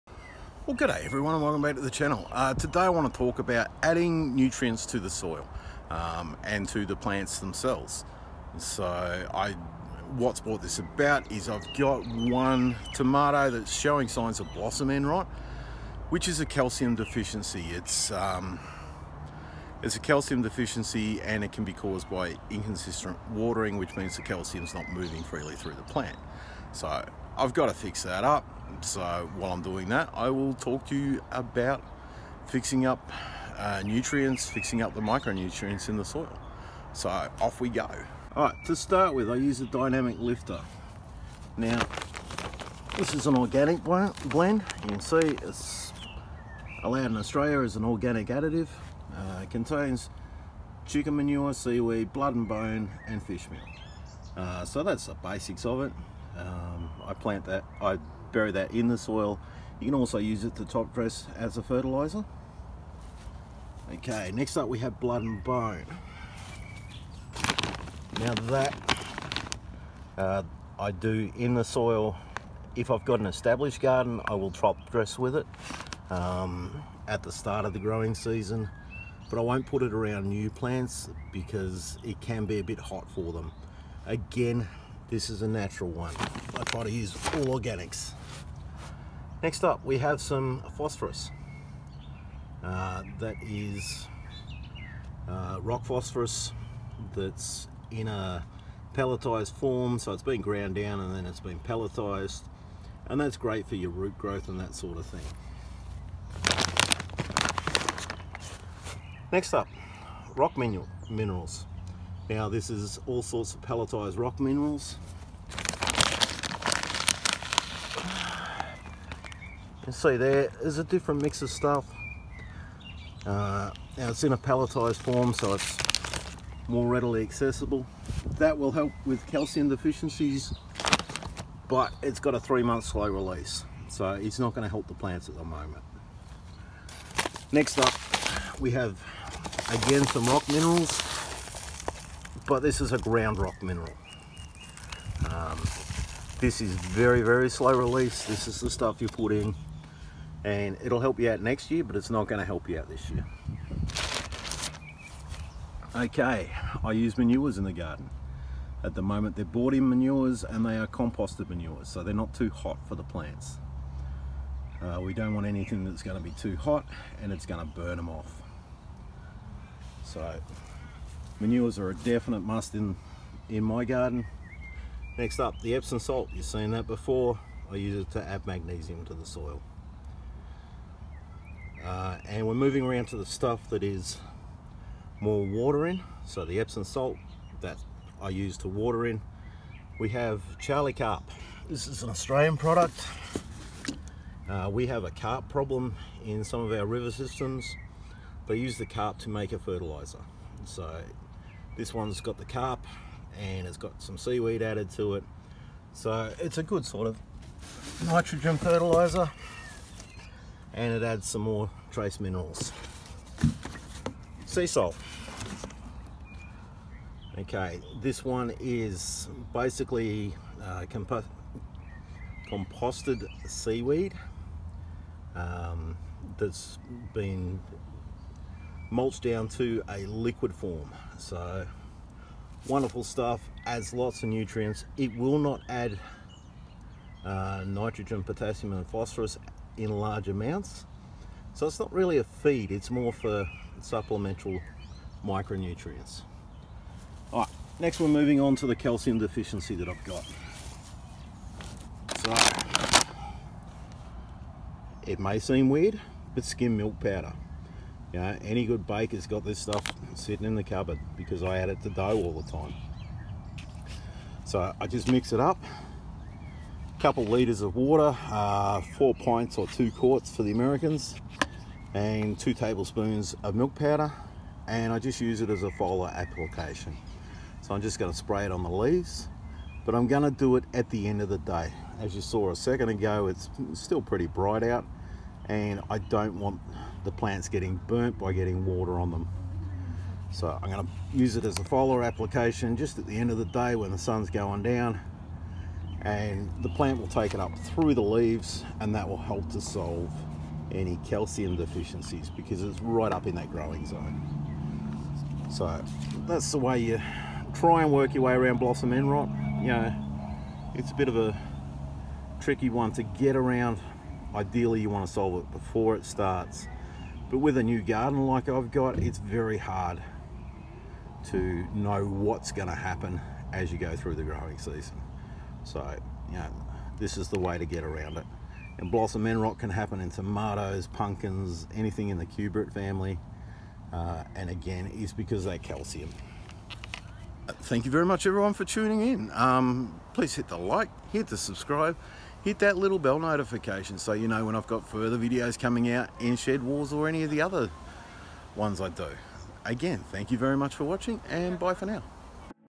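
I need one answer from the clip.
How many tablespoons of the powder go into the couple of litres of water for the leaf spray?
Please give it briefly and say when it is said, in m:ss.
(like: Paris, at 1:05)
2, at 4:32.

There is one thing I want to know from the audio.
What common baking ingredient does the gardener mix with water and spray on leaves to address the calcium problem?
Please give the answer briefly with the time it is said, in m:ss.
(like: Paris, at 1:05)
Skim milk powder, at 4:16.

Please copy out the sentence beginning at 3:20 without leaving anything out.
So this one's got the carp and it's got some seaweed added to it.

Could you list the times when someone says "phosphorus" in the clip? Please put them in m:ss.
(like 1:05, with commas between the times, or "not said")
1:30, 1:35, 3:58.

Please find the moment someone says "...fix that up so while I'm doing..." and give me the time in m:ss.
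0:27.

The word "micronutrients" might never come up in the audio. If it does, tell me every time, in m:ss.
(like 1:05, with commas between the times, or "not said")
0:35, 4:05.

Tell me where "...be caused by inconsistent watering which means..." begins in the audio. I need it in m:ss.
0:21.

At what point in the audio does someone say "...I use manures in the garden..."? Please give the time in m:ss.
2:36.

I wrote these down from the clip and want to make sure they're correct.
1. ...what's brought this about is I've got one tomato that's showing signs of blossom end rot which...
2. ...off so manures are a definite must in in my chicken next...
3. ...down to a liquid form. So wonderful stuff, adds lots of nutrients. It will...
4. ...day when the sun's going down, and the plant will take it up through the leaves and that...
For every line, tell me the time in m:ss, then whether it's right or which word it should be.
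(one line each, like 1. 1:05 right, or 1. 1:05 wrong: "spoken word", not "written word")
1. 0:10 right
2. 2:48 wrong: "garden", not "chicken"
3. 3:49 right
4. 4:53 right.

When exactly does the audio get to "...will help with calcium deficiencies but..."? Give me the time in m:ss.
2:08.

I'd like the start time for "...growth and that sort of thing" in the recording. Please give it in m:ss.
1:44.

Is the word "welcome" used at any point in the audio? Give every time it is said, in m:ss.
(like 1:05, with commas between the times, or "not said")
0:01.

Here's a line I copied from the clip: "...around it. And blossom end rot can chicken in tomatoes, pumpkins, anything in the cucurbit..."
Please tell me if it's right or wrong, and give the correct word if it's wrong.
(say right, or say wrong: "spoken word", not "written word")
wrong: "happen", not "chicken".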